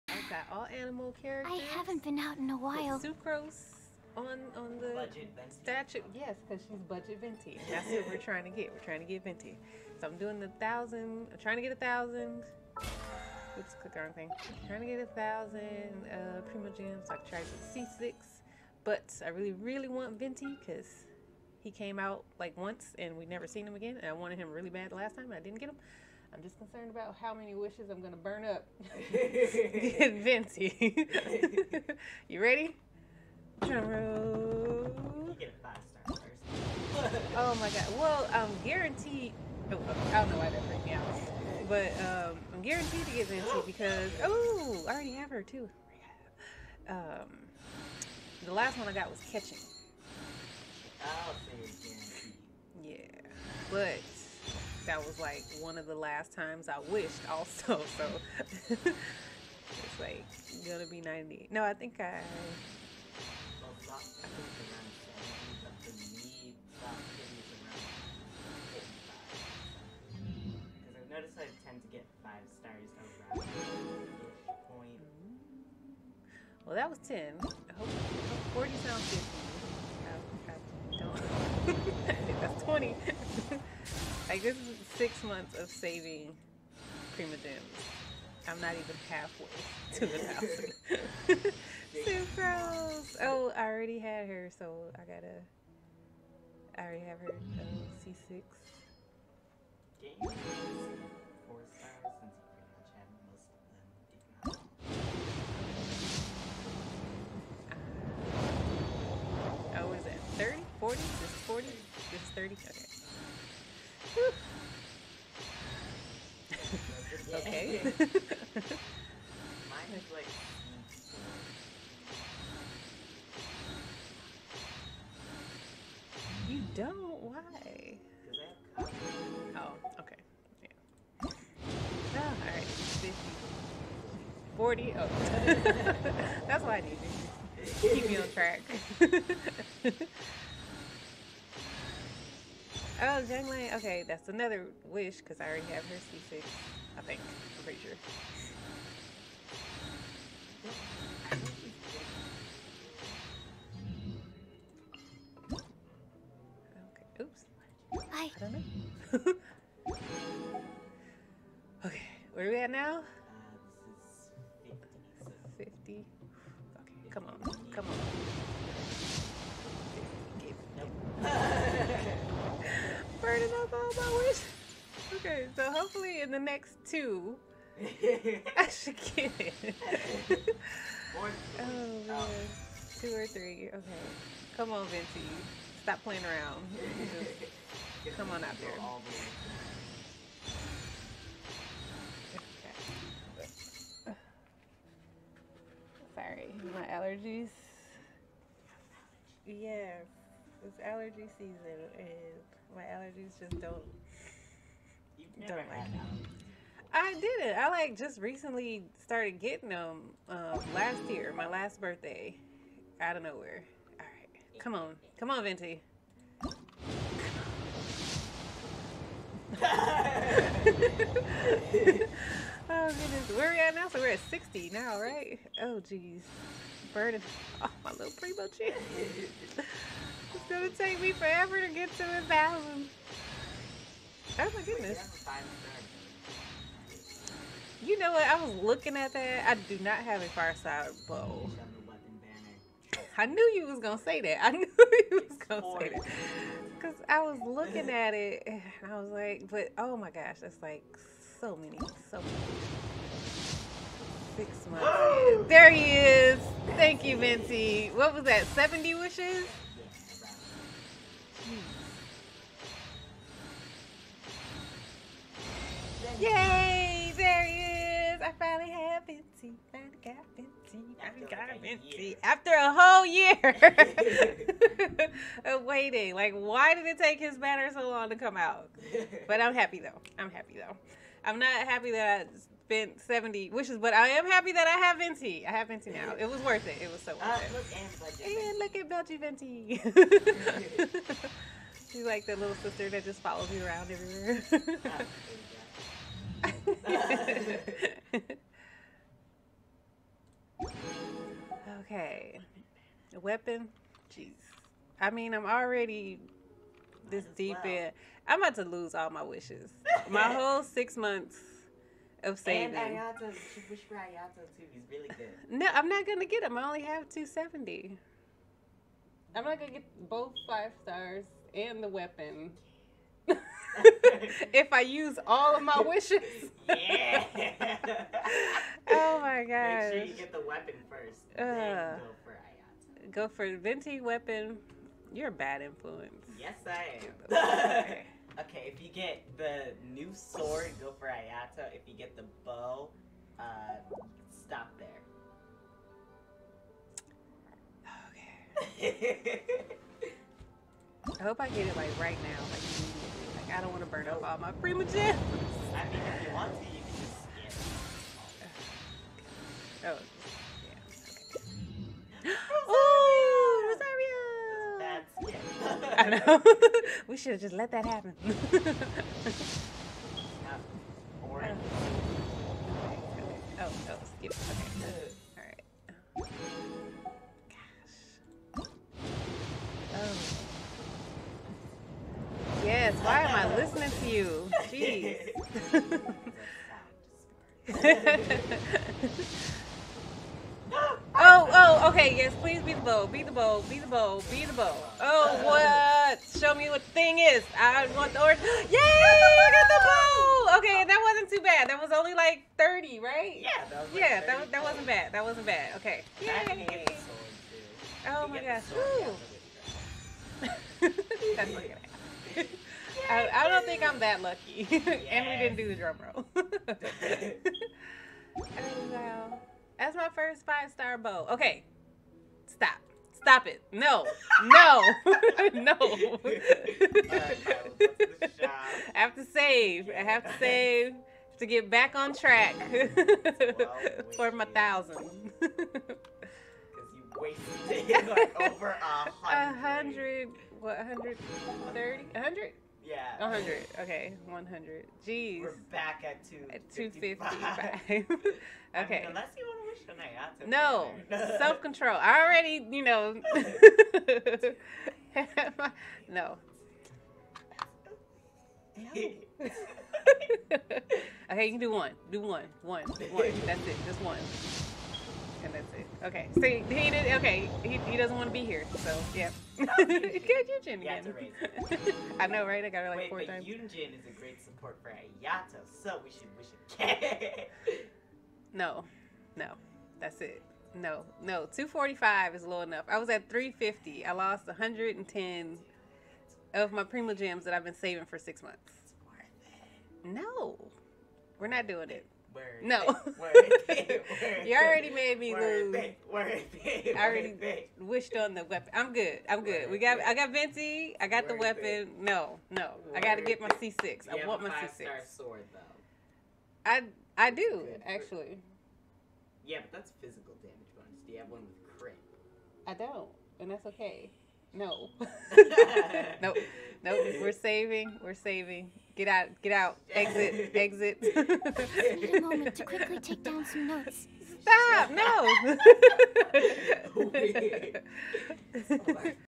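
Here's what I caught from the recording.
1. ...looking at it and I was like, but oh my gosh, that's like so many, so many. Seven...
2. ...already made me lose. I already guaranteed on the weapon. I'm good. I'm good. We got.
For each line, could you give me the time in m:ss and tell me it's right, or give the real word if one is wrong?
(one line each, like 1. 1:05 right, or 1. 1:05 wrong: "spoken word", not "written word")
1. 4:07 wrong: "Six", not "Seven"
2. 8:14 wrong: "wished", not "guaranteed".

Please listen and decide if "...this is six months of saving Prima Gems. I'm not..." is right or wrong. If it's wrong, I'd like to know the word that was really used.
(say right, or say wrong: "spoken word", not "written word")
right.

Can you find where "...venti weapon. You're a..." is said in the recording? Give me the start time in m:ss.
5:33.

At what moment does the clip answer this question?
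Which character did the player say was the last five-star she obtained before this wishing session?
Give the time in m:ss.
0:49.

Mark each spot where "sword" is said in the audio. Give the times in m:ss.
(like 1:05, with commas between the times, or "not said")
5:40, 8:25.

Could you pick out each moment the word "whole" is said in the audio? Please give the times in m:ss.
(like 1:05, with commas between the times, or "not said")
4:32, 5:10.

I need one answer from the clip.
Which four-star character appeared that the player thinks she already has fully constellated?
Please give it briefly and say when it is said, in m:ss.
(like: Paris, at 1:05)
Xiangling, at 2:23.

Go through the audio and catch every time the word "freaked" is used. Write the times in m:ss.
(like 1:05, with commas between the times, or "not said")
0:40.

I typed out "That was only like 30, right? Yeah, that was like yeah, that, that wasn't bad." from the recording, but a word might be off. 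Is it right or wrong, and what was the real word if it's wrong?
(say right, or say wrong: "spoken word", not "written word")
right.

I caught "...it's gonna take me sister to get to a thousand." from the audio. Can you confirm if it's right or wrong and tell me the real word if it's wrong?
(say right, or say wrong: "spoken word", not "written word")
wrong: "forever", not "sister".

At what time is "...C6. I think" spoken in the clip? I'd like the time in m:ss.
2:26.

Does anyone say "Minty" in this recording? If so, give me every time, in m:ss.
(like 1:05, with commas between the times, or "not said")
4:17.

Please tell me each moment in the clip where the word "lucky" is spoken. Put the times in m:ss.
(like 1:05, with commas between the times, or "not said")
6:54.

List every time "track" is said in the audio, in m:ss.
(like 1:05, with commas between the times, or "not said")
2:18, 7:12.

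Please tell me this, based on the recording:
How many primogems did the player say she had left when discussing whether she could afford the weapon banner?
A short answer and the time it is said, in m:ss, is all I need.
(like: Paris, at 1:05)
270, at 5:17.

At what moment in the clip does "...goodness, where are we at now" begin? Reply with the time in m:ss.
3:42.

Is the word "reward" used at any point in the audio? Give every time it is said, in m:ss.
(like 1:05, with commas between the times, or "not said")
not said.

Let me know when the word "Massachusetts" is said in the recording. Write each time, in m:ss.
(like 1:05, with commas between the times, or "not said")
not said.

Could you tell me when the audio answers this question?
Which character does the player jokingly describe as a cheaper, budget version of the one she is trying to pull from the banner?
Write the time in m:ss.
0:02.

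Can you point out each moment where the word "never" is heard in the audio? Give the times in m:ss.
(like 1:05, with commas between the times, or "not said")
0:23, 3:25.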